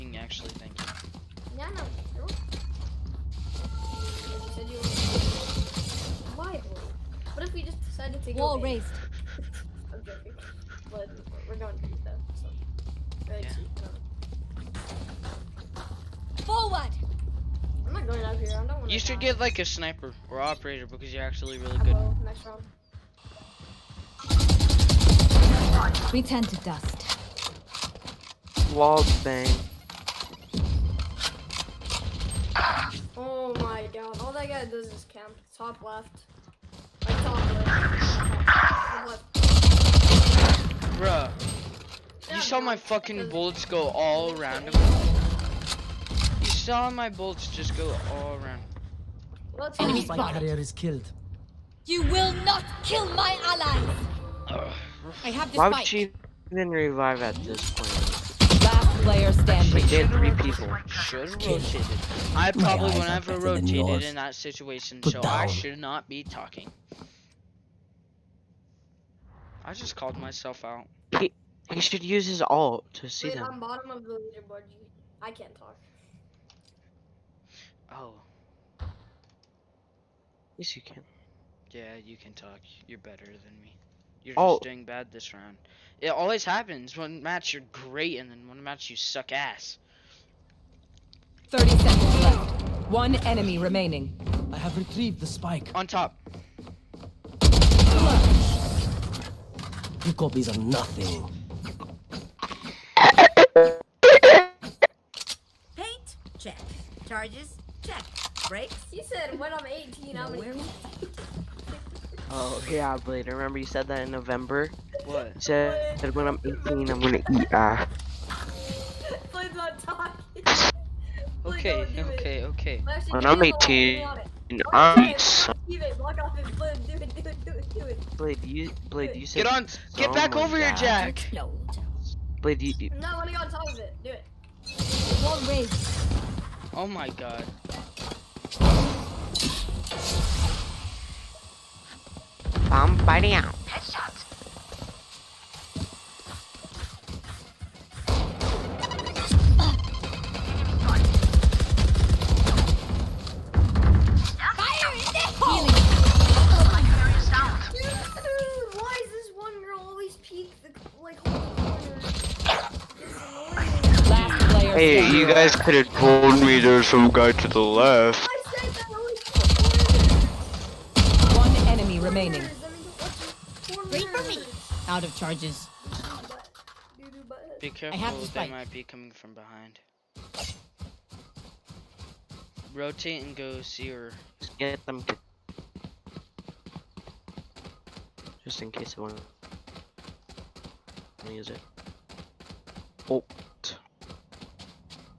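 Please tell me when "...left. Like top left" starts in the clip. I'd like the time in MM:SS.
00:35.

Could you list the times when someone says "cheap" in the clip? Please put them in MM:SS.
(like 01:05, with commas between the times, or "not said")
00:13.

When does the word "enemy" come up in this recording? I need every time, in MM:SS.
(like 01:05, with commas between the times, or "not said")
00:49, 01:33.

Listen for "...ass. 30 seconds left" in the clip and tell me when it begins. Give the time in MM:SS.
01:29.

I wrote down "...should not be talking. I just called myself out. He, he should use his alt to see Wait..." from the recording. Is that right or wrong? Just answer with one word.
right.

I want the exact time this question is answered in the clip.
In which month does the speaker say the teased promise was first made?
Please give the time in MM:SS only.
01:54.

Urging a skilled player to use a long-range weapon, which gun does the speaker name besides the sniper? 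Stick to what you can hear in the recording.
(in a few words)
Operator.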